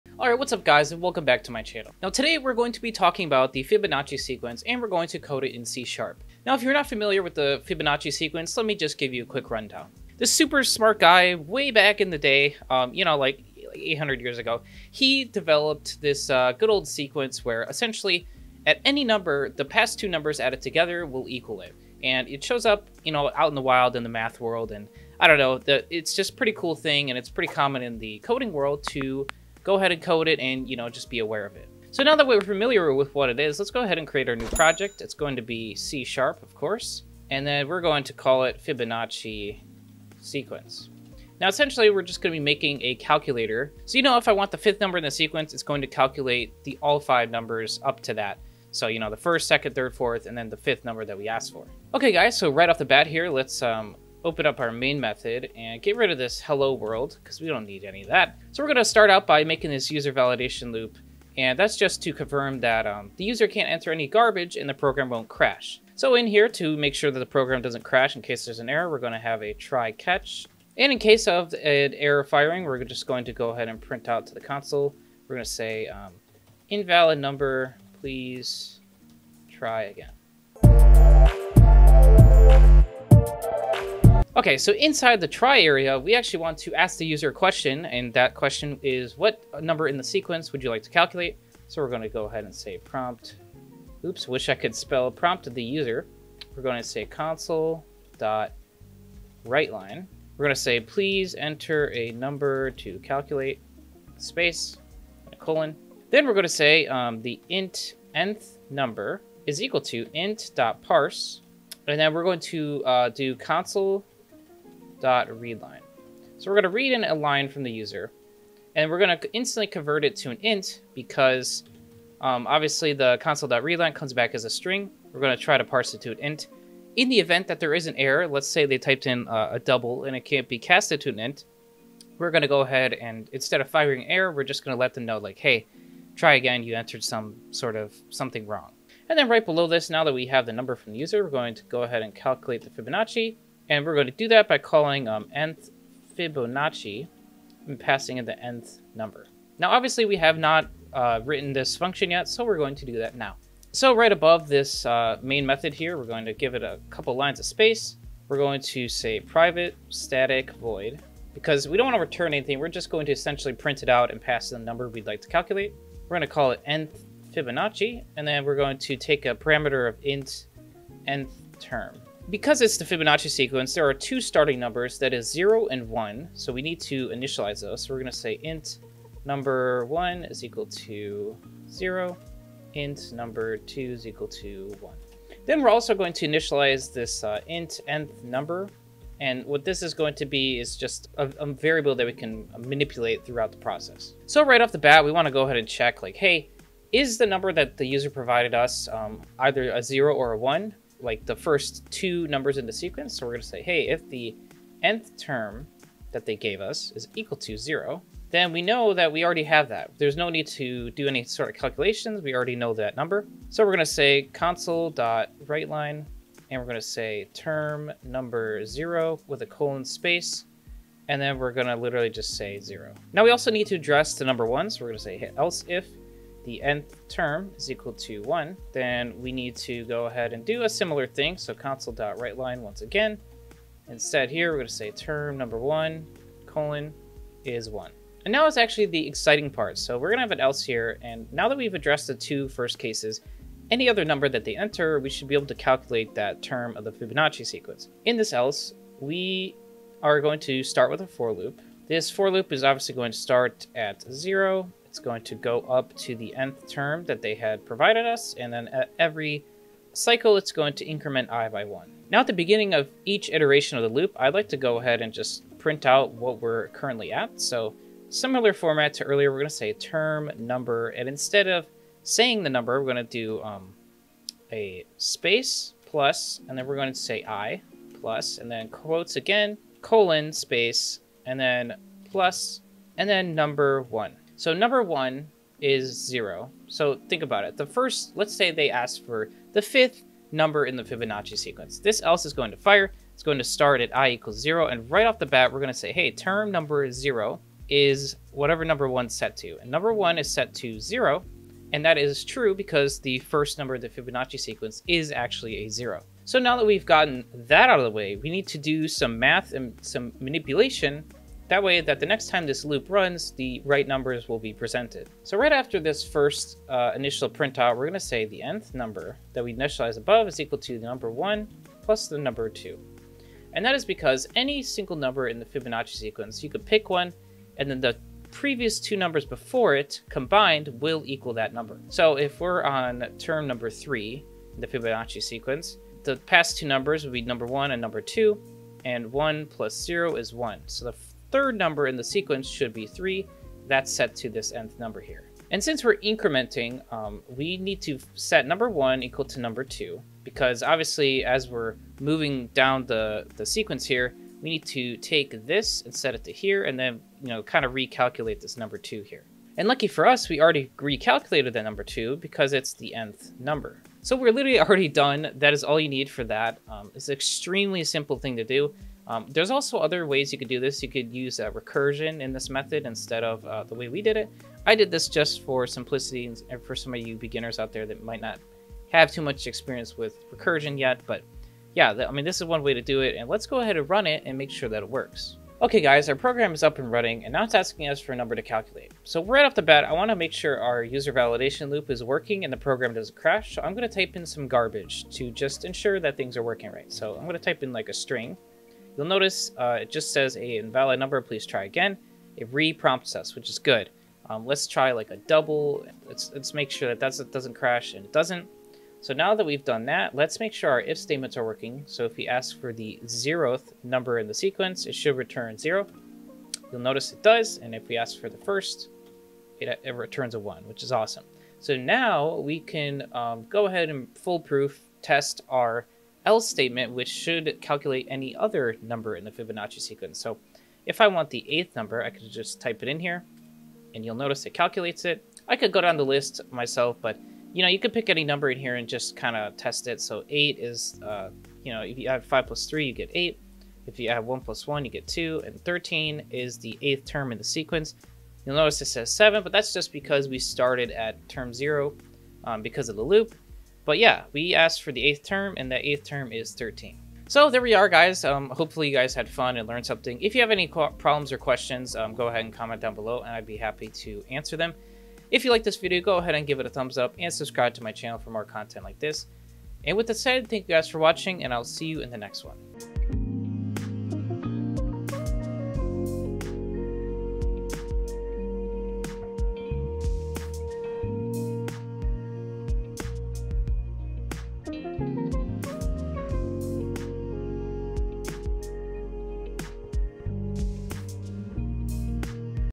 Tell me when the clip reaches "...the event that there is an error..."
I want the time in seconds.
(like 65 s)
127 s.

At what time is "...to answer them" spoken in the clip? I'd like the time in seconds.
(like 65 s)
463 s.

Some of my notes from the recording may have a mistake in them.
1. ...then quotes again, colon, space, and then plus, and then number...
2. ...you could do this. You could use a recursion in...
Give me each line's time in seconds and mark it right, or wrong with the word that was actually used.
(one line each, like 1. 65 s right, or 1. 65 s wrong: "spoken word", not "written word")
1. 278 s right
2. 370 s right.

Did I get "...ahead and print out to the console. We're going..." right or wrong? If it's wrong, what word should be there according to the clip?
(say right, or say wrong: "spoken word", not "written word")
right.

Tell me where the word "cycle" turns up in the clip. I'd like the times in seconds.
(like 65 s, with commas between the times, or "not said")
259 s.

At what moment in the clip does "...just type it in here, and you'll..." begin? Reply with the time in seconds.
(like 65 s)
432 s.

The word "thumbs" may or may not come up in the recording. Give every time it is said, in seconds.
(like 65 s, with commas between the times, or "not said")
466 s.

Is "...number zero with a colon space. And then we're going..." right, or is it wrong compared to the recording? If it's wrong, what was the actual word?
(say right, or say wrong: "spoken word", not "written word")
right.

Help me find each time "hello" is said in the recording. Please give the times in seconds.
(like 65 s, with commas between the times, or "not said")
56 s.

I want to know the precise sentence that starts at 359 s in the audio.
And lucky for us, we already recalculated that number 2 because it's the nth number.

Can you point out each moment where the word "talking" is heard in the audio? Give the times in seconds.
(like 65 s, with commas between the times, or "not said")
2 s.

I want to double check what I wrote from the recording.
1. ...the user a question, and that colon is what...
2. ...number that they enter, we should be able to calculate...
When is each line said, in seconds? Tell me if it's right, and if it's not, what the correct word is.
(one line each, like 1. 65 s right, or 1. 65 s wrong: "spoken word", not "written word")
1. 86 s wrong: "question", not "colon"
2. 244 s right.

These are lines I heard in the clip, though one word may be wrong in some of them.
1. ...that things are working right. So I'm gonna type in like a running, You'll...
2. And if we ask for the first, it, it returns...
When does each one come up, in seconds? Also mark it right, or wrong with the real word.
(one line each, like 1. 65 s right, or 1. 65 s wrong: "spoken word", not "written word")
1. 395 s wrong: "string", not "running"
2. 417 s right.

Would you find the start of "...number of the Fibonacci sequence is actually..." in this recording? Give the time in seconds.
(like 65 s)
303 s.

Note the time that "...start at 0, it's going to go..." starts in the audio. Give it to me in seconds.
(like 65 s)
253 s.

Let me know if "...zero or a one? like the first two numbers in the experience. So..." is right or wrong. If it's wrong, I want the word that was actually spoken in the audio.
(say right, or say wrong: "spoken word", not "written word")
wrong: "sequence", not "experience".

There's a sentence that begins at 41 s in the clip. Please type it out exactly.
Now, essentially, we're just going to be making a calculator.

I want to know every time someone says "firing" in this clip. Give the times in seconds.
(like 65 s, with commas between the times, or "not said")
72 s, 133 s.